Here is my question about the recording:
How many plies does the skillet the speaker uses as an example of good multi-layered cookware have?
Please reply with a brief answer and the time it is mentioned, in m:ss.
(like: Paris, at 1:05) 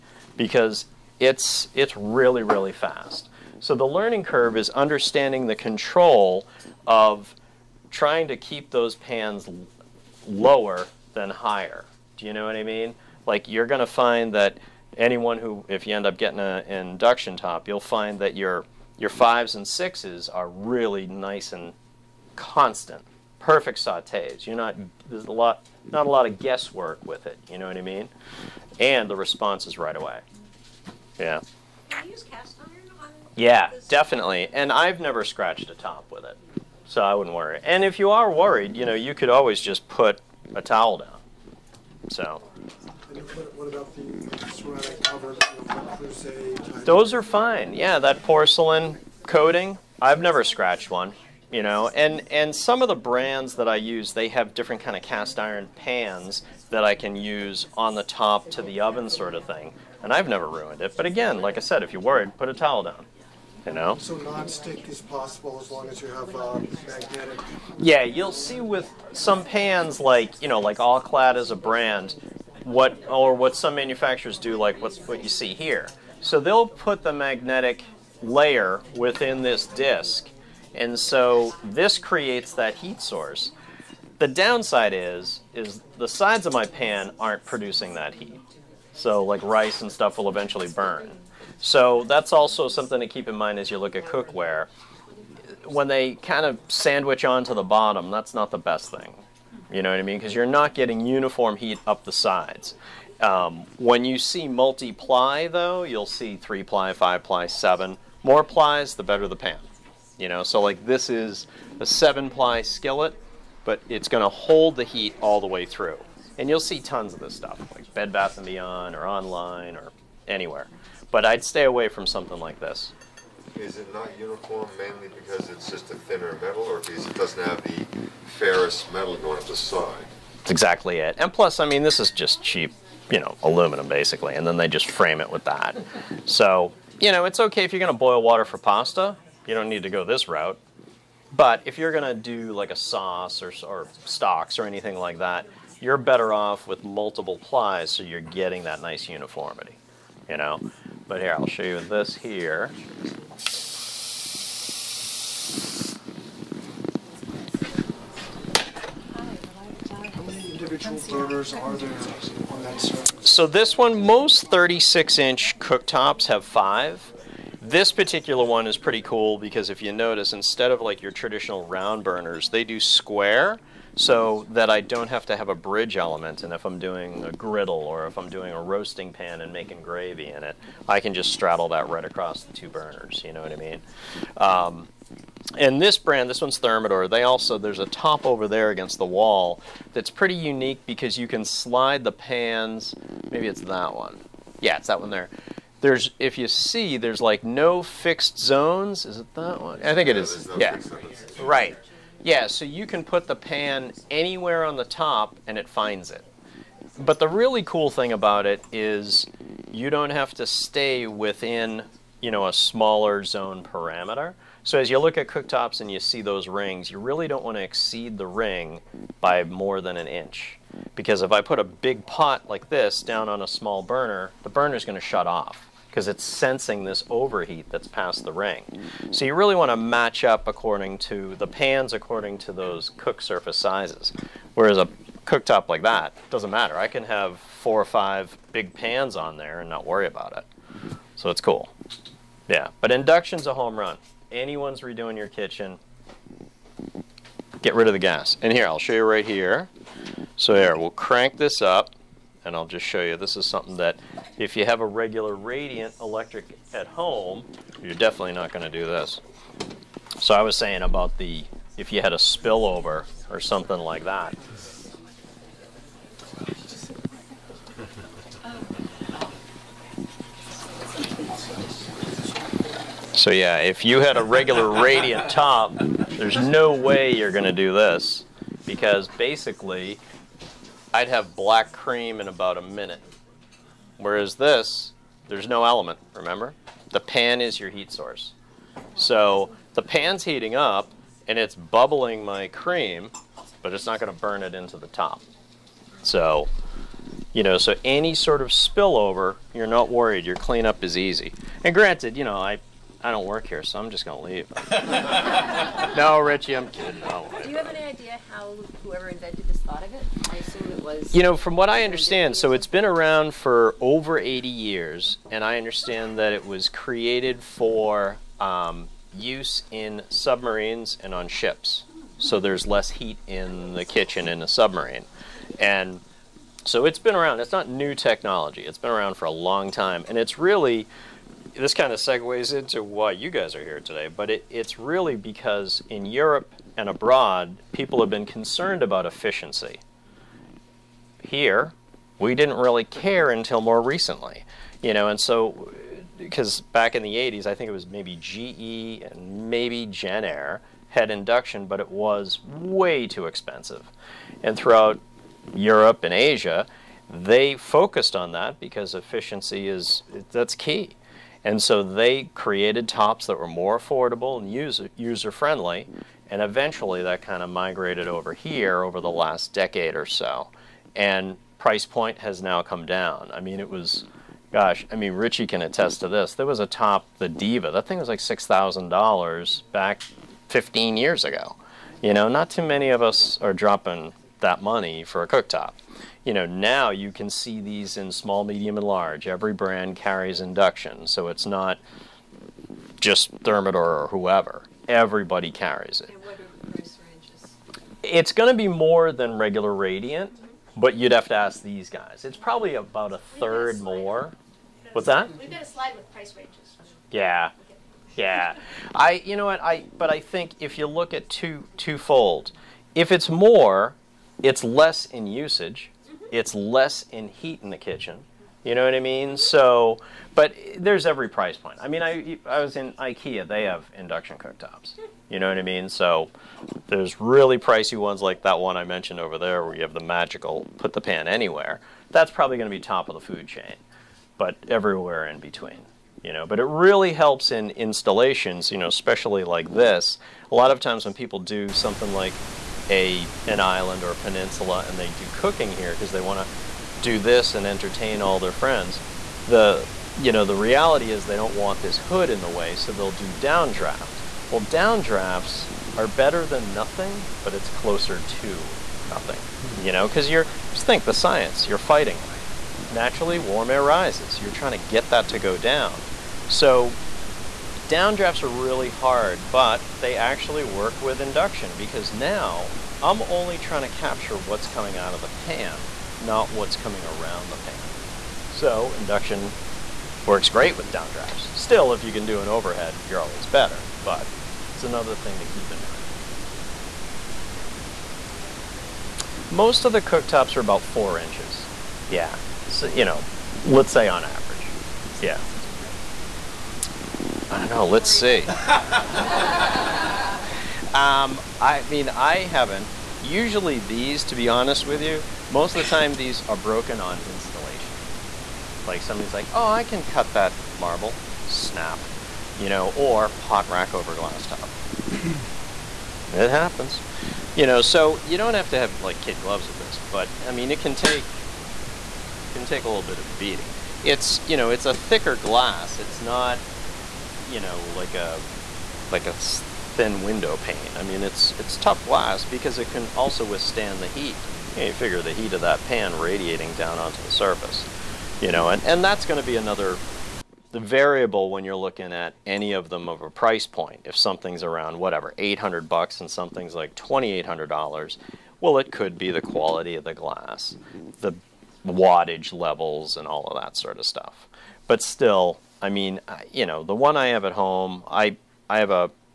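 7, at 1:51.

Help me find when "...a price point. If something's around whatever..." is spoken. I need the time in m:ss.
9:03.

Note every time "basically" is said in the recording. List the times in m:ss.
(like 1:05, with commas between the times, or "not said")
2:13, 4:39.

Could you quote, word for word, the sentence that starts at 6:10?
And price point has now come down.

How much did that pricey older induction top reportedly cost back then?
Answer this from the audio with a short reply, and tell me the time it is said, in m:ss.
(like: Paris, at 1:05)
$6,000, at 6:18.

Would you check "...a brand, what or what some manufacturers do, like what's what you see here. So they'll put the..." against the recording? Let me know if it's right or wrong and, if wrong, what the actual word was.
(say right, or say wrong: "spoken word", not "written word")
right.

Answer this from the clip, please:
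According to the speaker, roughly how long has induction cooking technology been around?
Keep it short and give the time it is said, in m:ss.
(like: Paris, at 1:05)
over 80 years, at 5:13.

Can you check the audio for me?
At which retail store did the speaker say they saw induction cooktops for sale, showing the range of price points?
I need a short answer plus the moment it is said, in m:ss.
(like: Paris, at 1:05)
IKEA, at 7:02.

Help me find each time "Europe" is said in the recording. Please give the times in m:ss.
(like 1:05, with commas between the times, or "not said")
5:36, 5:55.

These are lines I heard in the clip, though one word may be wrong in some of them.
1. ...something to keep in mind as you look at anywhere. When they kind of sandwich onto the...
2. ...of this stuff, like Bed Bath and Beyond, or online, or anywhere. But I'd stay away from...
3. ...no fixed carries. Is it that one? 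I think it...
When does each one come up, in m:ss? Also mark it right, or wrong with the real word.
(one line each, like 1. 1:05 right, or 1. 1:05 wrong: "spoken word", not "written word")
1. 1:32 wrong: "cookware", not "anywhere"
2. 1:57 right
3. 3:17 wrong: "zones", not "carries".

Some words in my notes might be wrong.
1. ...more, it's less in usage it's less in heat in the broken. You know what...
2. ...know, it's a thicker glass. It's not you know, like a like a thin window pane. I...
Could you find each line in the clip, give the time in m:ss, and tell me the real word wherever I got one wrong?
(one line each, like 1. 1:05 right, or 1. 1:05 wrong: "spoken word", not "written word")
1. 6:53 wrong: "kitchen", not "broken"
2. 8:44 right.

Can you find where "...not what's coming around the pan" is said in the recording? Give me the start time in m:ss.
7:56.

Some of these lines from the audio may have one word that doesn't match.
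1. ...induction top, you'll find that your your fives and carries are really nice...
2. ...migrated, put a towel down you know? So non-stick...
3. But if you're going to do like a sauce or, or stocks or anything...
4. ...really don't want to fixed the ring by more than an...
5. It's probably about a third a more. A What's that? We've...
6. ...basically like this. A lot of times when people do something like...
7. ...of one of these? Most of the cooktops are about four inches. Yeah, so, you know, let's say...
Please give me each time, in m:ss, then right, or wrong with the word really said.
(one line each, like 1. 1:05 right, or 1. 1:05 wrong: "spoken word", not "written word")
1. 0:16 wrong: "sixes", not "carries"
2. 1:02 wrong: "worried", not "migrated"
3. 2:21 right
4. 3:36 wrong: "exceed", not "fixed"
5. 6:42 right
6. 7:18 wrong: "especially", not "basically"
7. 8:08 right.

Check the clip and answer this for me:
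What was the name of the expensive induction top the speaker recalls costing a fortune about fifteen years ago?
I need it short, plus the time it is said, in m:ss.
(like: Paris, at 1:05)
Diva, at 6:17.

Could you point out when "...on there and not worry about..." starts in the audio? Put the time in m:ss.
3:59.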